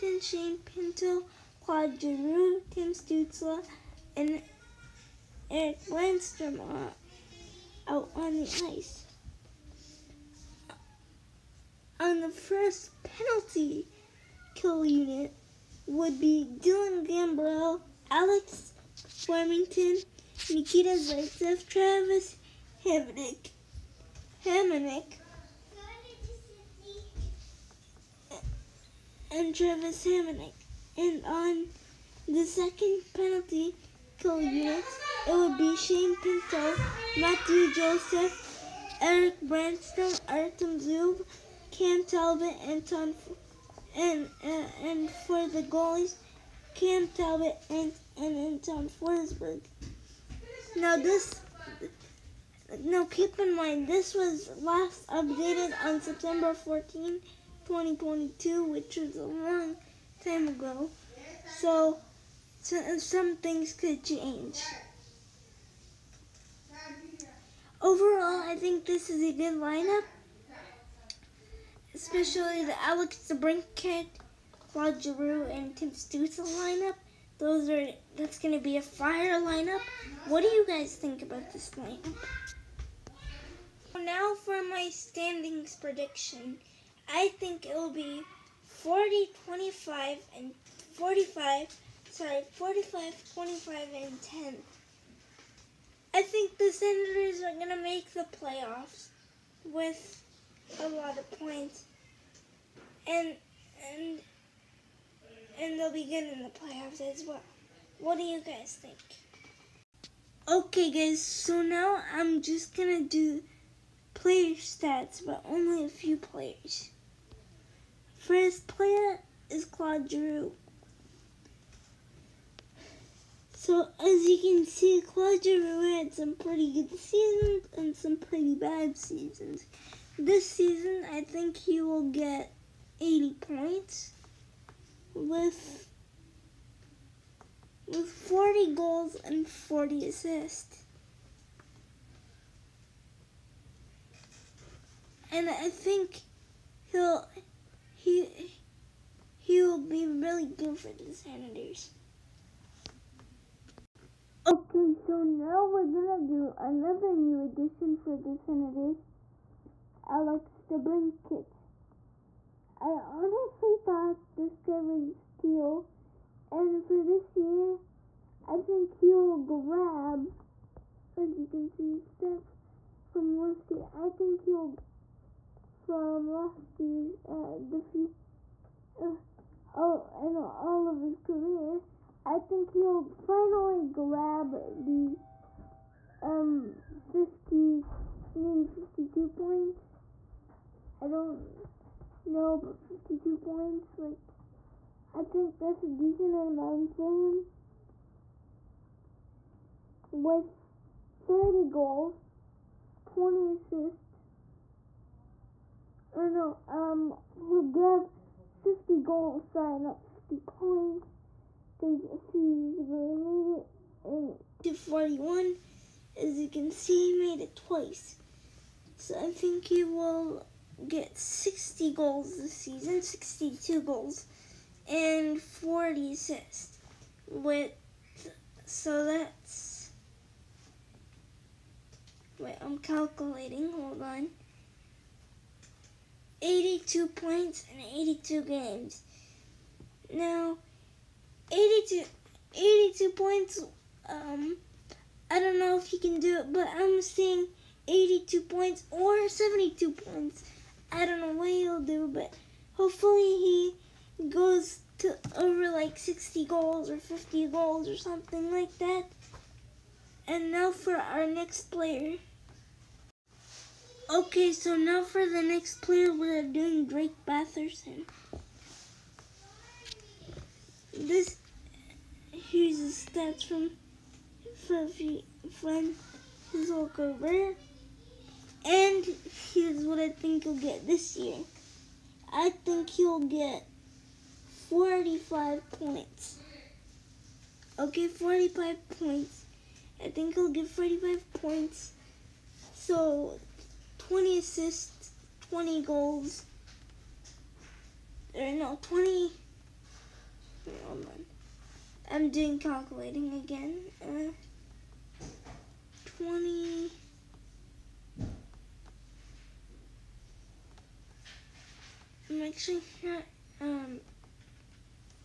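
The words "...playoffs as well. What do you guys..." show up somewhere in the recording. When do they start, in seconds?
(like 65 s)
106 s.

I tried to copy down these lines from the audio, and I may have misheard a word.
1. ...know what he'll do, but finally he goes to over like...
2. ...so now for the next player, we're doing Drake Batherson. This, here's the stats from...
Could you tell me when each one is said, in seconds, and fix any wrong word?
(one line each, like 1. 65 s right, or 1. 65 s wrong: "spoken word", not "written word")
1. 251 s wrong: "hopefully", not "finally"
2. 264 s right.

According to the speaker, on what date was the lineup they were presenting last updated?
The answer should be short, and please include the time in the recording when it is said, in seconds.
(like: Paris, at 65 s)
September 14, 2022, at 56 s.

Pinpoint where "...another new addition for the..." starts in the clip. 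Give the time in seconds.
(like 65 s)
156 s.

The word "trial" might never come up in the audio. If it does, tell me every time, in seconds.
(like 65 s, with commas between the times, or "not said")
not said.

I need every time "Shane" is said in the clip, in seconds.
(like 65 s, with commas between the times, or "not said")
0 s, 35 s.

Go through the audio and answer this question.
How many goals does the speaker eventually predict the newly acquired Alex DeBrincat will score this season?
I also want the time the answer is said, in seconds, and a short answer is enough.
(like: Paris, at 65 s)
62 goals, at 223 s.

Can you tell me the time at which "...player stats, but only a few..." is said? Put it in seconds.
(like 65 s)
114 s.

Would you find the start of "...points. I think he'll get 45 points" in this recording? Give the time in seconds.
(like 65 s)
288 s.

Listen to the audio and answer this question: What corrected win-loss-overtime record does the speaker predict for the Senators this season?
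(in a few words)
45, 25, and 10.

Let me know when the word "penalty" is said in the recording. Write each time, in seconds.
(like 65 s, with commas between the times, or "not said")
13 s, 33 s.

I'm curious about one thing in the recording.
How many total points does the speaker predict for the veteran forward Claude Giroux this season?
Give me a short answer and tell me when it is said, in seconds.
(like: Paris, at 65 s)
80 points, at 133 s.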